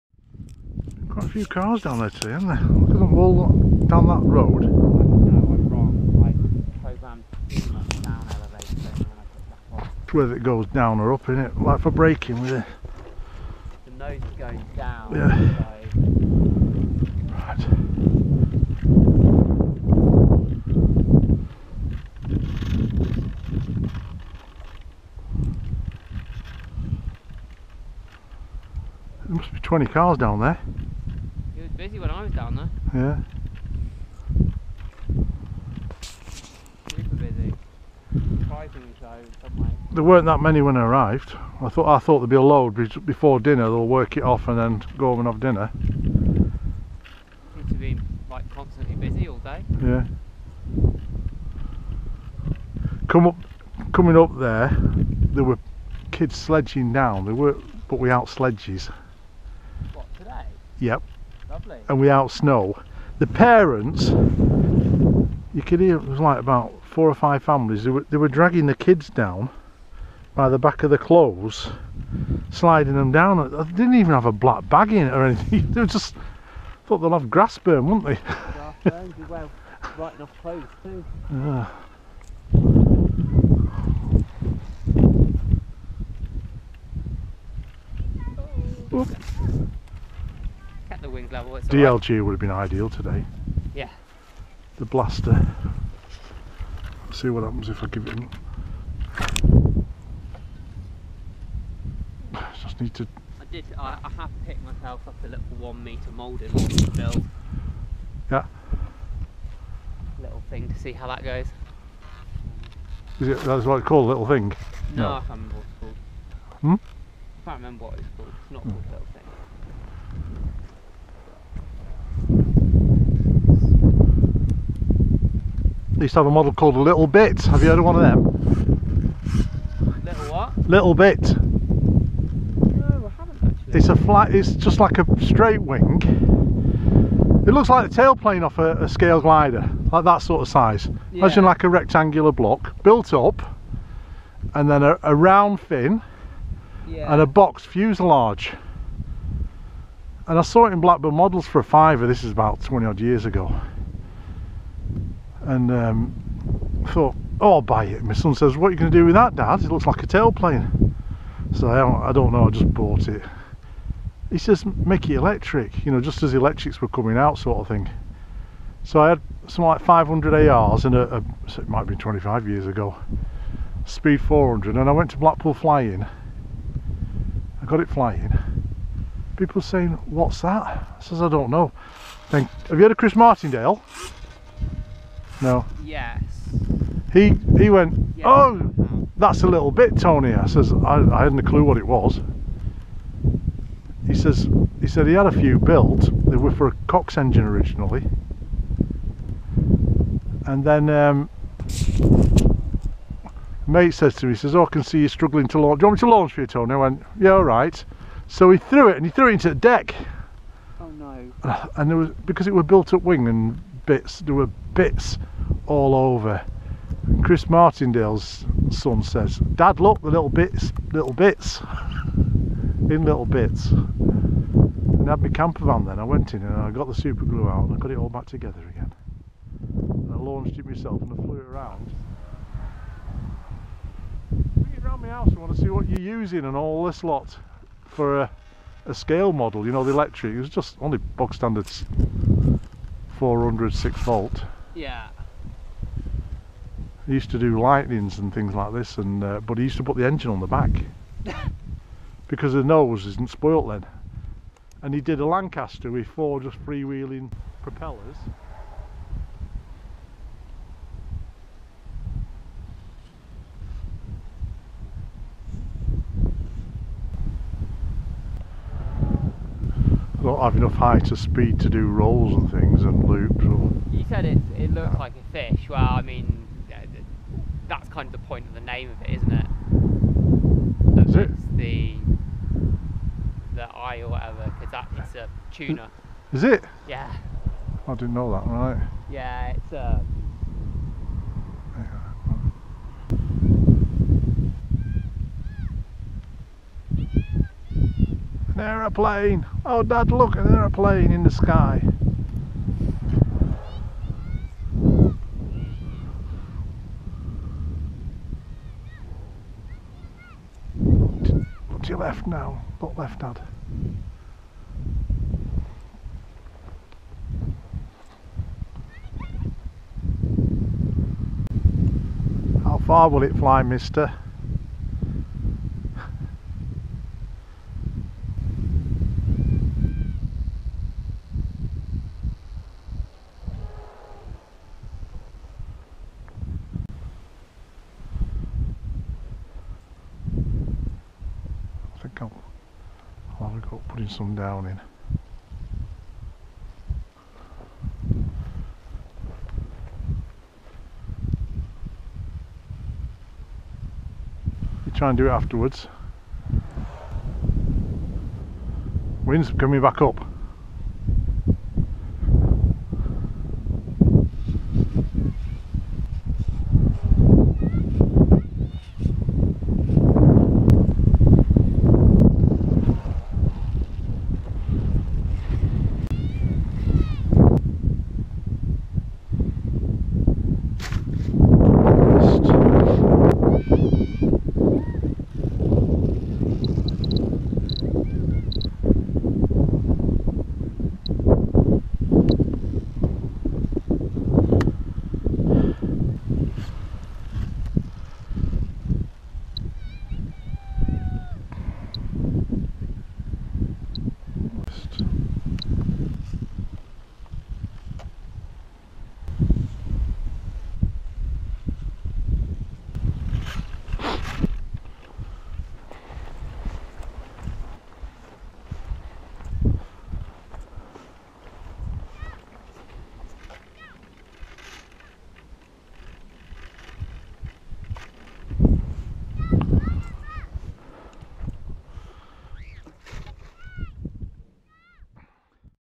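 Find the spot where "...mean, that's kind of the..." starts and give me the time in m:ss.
4:36.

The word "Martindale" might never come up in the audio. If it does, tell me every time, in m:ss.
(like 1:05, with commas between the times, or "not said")
3:03, 3:37.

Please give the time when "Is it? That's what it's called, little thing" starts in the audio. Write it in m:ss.
1:53.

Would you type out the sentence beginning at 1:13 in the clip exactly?
They didn't even have a black bag in it or anything.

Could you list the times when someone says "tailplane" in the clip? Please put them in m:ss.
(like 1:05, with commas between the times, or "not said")
2:17, 2:40.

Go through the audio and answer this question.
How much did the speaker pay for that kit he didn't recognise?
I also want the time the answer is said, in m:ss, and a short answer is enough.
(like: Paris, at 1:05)
a fiver, at 2:31.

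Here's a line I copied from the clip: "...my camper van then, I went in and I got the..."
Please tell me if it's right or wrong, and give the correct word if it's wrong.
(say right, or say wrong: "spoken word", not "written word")
right.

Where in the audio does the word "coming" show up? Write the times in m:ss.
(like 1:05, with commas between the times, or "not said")
0:53, 2:46, 5:59.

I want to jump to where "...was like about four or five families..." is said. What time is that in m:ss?
1:06.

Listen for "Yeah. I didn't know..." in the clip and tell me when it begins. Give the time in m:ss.
4:46.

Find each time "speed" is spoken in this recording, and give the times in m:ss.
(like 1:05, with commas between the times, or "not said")
2:53, 4:31.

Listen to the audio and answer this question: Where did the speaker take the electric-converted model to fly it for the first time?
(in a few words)
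Blackpool.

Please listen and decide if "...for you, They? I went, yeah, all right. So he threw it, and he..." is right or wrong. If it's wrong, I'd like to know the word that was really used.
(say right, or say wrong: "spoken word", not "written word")
wrong: "Tony", not "They".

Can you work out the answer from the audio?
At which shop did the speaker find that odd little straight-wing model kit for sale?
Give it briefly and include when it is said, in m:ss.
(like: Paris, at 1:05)
Blackburn Models, at 2:30.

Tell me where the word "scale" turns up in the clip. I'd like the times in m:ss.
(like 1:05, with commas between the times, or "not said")
2:18, 3:58.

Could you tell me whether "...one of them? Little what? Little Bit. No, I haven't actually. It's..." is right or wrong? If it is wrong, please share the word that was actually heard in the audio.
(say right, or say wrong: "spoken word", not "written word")
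right.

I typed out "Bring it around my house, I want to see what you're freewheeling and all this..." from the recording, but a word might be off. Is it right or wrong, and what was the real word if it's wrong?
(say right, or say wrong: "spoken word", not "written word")
wrong: "using", not "freewheeling".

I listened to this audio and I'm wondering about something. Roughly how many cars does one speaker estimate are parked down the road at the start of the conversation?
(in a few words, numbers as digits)
20.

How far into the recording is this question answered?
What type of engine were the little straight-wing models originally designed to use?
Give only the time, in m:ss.
3:16.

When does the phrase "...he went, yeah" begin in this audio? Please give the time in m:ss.
3:07.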